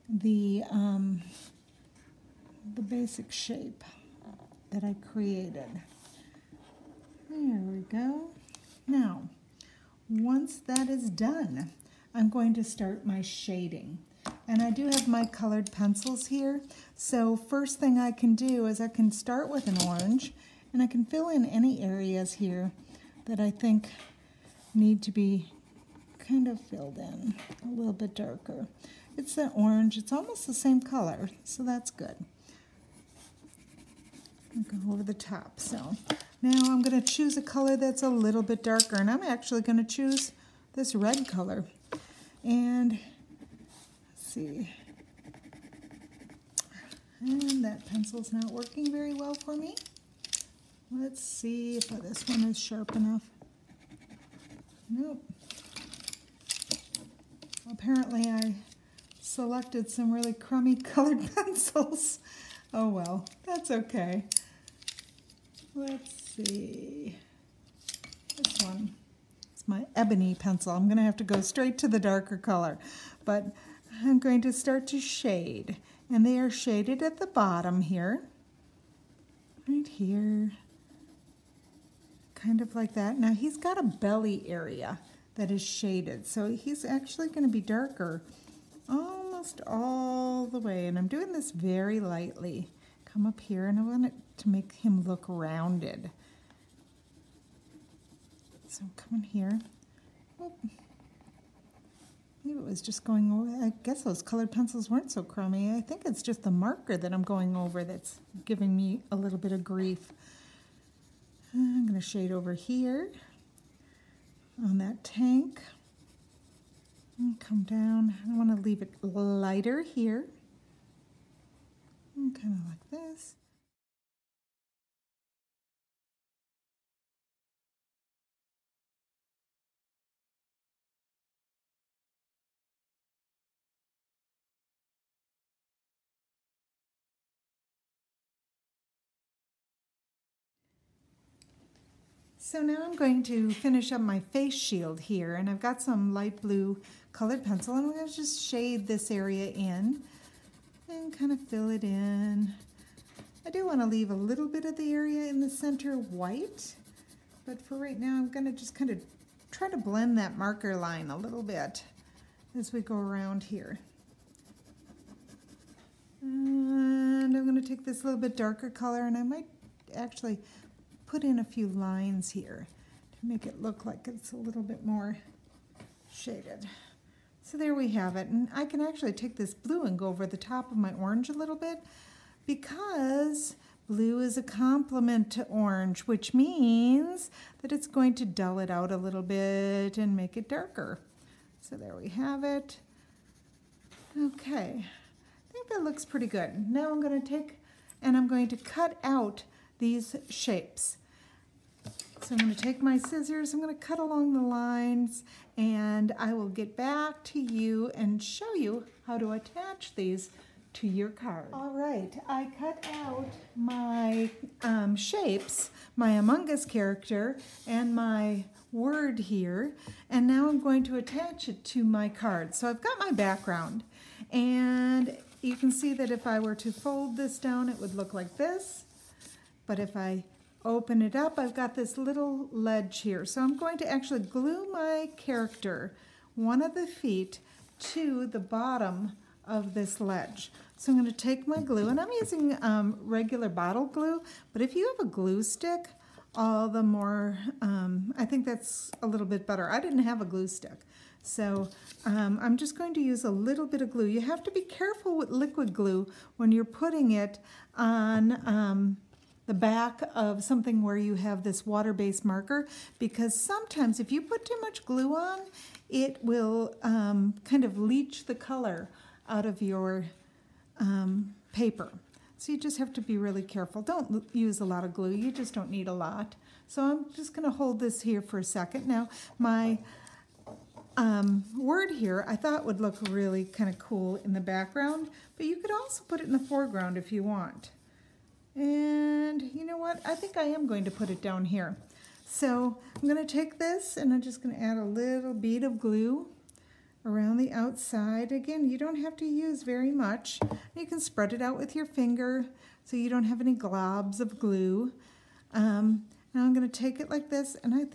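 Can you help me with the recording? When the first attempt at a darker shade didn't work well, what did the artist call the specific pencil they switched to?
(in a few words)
ebony pencil.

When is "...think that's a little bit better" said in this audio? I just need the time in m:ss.
4:08.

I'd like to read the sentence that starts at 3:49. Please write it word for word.
But if I open it up, I've got this little ledge here.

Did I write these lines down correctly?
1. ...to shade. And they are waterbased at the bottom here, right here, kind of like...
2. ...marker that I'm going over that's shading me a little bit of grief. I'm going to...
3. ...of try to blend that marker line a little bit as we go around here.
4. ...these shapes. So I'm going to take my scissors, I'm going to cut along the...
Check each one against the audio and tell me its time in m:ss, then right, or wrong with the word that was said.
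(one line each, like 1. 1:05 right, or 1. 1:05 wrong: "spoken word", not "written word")
1. 1:14 wrong: "shaded", not "waterbased"
2. 1:46 wrong: "giving", not "shading"
3. 2:38 right
4. 3:19 right.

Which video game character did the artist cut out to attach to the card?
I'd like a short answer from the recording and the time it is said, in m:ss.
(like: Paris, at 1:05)
Among Us, at 3:36.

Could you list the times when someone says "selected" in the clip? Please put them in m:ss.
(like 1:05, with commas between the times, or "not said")
0:59.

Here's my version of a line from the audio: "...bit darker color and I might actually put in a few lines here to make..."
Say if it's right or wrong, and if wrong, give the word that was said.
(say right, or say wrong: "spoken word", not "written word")
right.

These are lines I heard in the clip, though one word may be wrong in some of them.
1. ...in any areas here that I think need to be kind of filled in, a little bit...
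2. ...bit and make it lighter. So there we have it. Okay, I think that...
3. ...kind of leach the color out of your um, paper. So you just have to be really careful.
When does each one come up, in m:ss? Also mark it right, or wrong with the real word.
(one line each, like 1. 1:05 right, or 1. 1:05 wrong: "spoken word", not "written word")
1. 0:21 right
2. 3:09 wrong: "darker", not "lighter"
3. 4:27 right.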